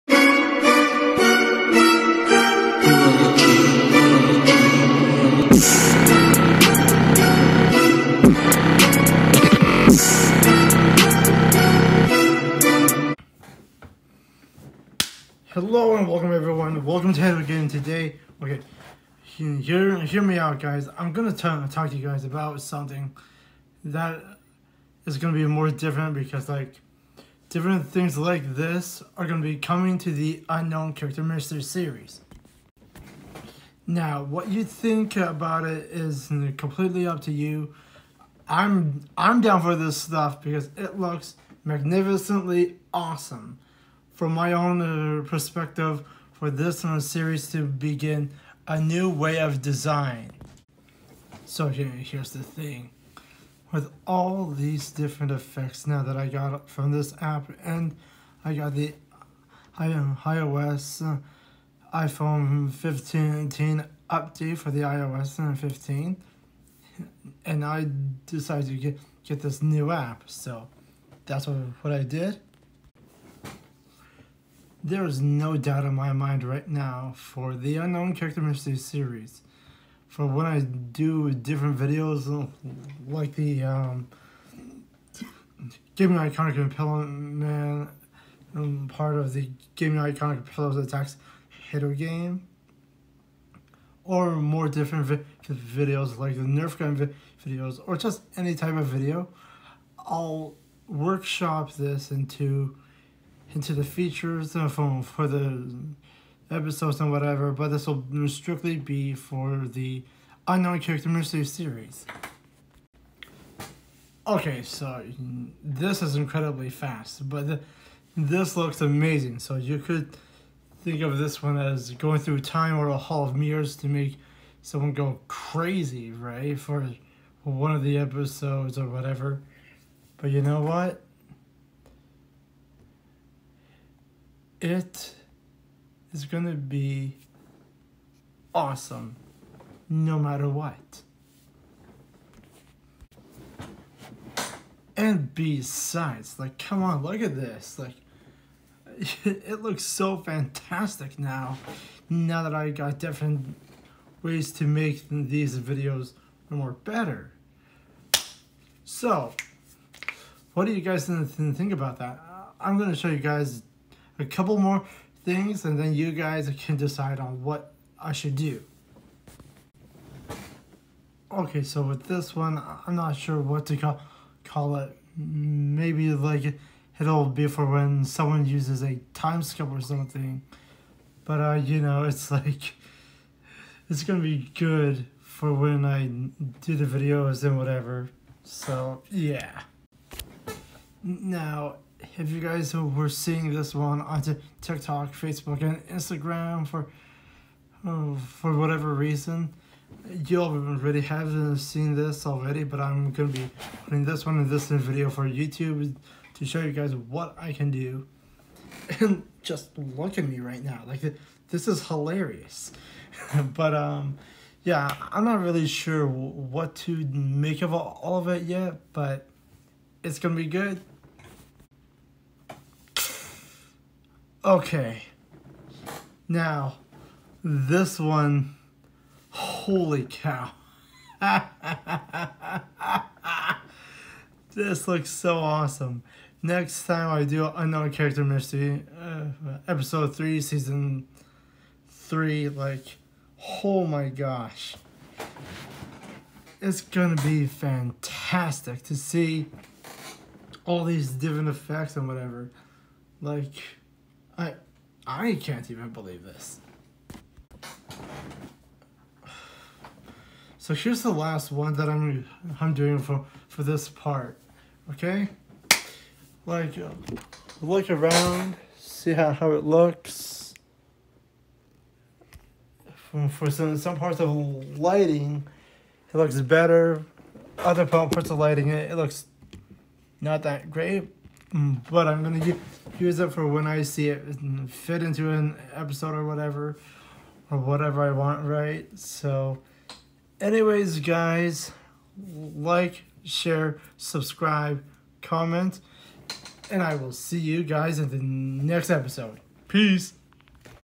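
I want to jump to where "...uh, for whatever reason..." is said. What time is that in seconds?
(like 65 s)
197 s.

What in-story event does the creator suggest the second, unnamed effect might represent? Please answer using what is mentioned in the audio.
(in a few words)
a time skip.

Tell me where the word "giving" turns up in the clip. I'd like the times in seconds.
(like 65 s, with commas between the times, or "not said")
not said.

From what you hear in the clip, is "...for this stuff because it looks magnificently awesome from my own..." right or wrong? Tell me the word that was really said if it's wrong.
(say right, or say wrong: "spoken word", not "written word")
right.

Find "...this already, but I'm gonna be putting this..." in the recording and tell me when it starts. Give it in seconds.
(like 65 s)
201 s.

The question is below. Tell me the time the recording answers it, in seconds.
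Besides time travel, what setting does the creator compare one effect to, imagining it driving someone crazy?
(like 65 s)
122 s.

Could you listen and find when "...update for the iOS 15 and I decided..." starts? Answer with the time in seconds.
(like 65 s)
64 s.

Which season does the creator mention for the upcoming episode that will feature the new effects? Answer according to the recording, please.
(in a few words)
season 3.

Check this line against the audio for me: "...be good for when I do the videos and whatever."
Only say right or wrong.
right.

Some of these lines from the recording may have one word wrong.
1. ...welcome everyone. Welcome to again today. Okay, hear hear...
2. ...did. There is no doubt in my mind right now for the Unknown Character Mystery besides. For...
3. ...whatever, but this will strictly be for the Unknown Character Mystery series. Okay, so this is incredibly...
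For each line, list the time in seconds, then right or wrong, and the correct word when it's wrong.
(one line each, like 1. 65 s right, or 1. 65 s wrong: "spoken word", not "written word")
1. 16 s right
2. 72 s wrong: "series", not "besides"
3. 107 s right.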